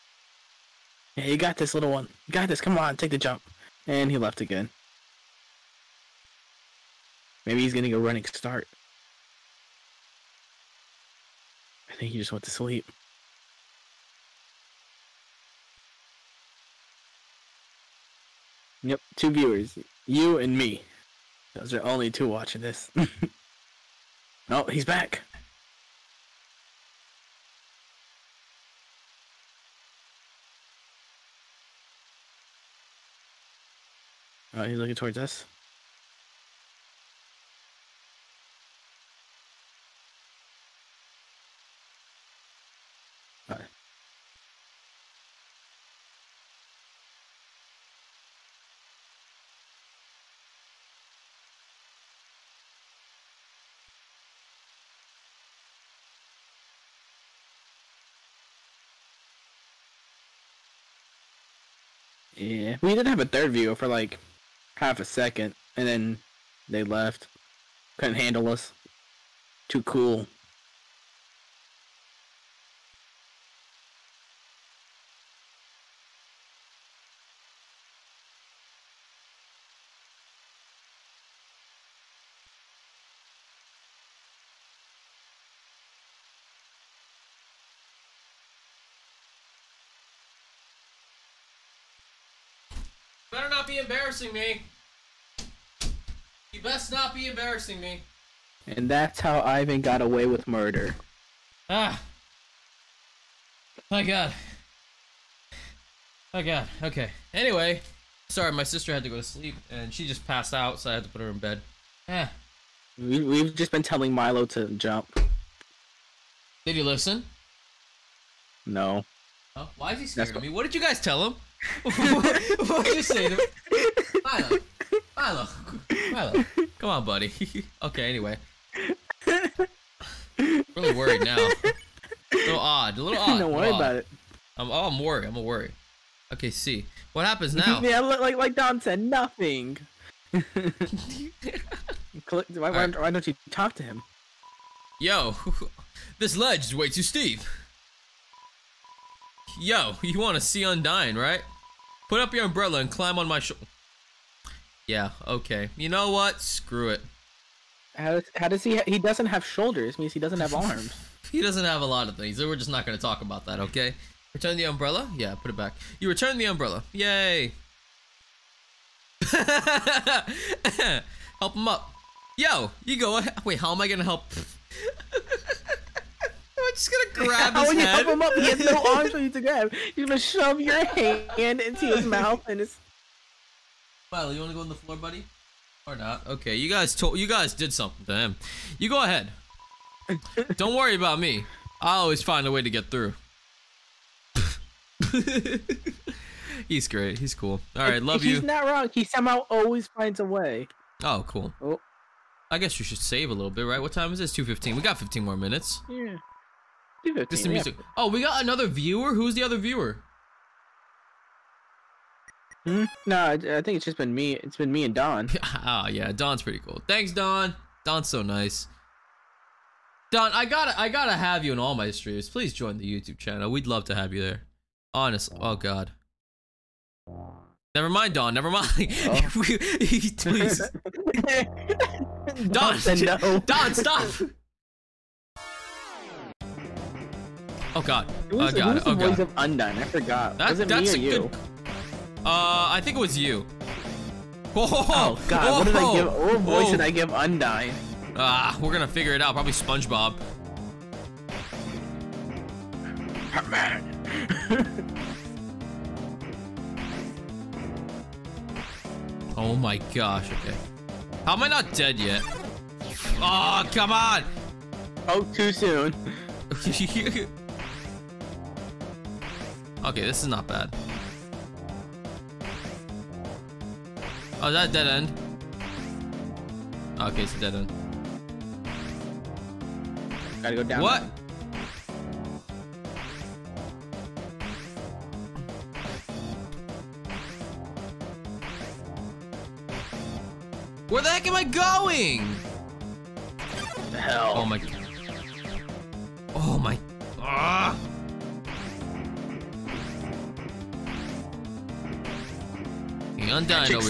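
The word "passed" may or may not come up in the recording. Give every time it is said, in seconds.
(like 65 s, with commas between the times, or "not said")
110 s.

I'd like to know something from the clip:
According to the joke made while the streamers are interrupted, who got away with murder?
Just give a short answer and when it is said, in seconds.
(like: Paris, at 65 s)
Ivan, at 99 s.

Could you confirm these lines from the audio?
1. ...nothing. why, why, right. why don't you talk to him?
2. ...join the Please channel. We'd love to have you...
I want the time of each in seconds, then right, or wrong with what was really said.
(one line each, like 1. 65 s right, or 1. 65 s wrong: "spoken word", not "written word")
1. 138 s right
2. 222 s wrong: "YouTube", not "Please".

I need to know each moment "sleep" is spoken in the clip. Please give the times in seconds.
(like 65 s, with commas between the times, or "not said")
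12 s, 109 s.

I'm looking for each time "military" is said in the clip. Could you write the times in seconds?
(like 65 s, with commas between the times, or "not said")
not said.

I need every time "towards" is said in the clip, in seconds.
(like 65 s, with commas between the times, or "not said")
34 s.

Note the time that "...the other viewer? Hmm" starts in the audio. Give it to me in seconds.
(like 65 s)
209 s.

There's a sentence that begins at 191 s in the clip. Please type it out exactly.
I always find a way to get through.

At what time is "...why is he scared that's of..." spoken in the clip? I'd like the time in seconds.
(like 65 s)
119 s.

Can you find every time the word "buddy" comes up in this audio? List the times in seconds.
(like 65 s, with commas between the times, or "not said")
127 s, 184 s.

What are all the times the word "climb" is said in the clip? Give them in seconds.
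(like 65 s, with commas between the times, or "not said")
152 s.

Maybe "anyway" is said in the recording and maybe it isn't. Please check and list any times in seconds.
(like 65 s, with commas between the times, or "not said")
107 s, 128 s.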